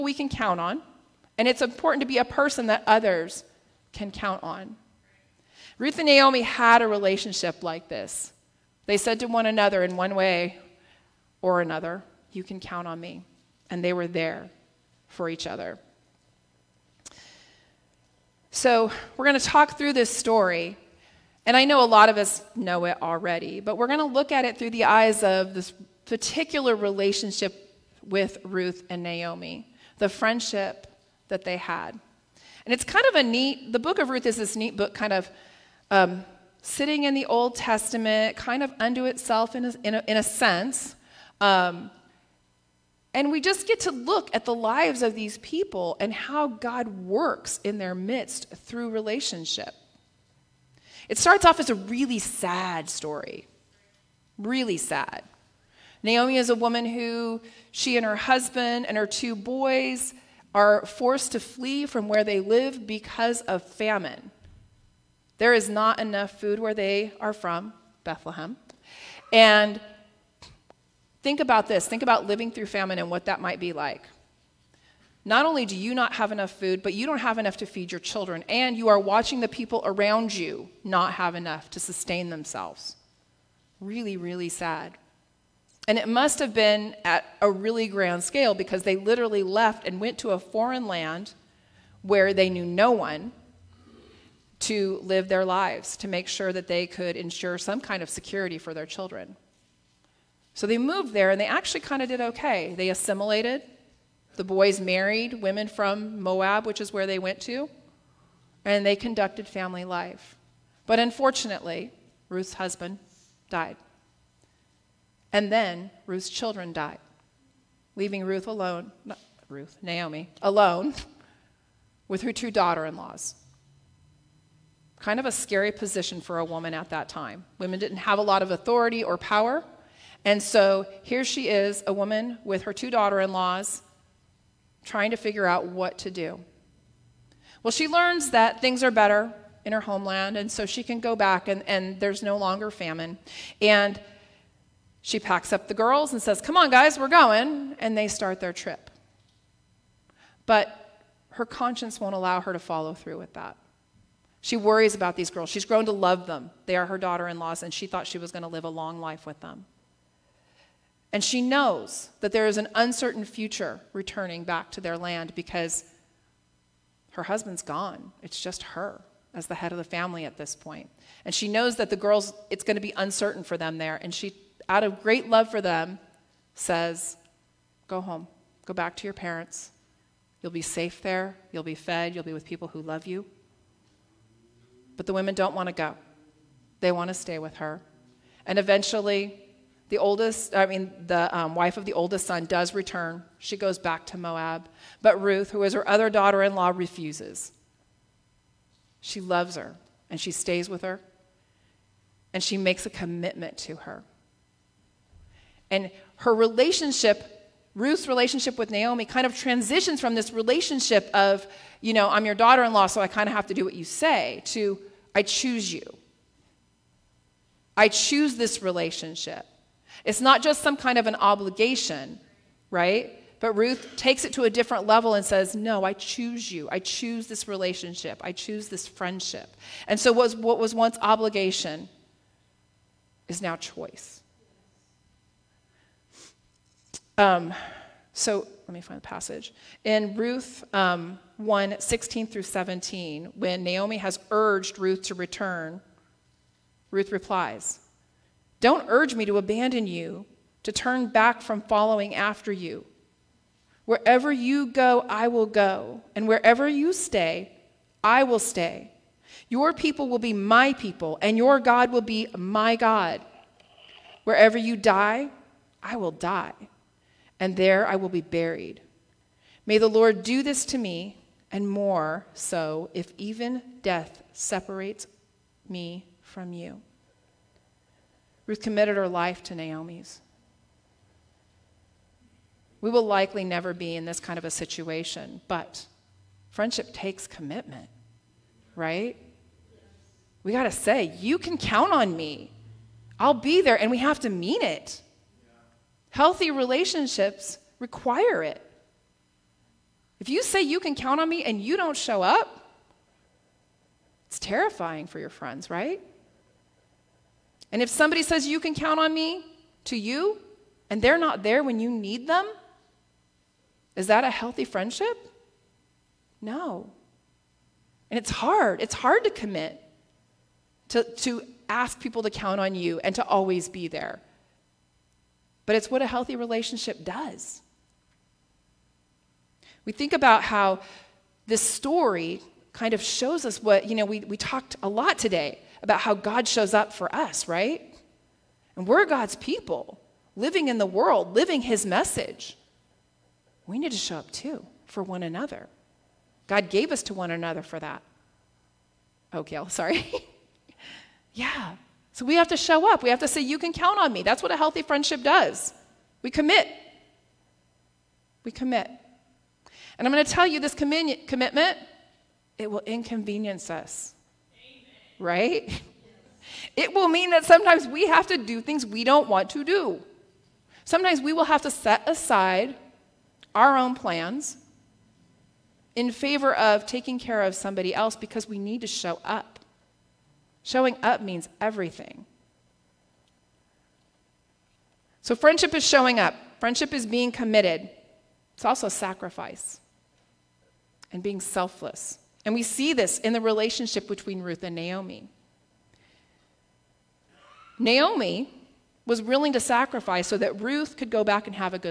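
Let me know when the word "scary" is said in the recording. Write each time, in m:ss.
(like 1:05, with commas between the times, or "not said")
2:05.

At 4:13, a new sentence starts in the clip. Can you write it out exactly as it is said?
Wherever you go, I will go, and wherever you stay, I will stay.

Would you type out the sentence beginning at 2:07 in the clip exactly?
Women didn't have a lot of authority or power.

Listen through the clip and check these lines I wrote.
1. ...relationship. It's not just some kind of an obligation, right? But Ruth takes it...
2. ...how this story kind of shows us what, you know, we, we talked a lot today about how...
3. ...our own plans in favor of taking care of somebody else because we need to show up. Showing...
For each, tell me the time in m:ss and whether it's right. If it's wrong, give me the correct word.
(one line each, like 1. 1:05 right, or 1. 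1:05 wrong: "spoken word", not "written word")
1. 3:38 right
2. 5:30 right
3. 6:13 right.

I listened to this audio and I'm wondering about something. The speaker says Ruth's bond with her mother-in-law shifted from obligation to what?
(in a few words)
Choice.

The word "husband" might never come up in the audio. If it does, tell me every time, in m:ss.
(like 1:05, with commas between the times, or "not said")
0:58, 1:52, 2:47.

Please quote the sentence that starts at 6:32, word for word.
And we see this in the relationship between Ruth and Naomi.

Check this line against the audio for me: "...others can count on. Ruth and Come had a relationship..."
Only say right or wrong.
wrong.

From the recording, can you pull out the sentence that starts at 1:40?
So they moved there and they actually kind of did okay.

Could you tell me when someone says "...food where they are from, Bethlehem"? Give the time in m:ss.
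1:06.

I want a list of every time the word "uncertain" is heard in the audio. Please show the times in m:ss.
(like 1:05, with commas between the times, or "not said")
2:42, 2:52.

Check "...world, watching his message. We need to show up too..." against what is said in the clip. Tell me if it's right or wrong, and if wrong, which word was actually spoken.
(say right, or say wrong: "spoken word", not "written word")
wrong: "living", not "watching".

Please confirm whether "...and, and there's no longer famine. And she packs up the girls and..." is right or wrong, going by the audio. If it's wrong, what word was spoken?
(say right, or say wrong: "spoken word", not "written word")
right.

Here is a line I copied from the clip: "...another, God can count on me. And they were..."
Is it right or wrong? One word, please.
wrong.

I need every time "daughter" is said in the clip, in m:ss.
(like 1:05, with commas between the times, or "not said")
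2:02, 2:12, 2:36, 3:16, 3:32.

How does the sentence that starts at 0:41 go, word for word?
Um, and we just get to look at the lives of these people and how God works in their midst through relationship.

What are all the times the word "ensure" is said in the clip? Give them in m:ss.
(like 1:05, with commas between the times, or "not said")
1:37.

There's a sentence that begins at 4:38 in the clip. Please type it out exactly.
Ruth committed her life to Naomi's.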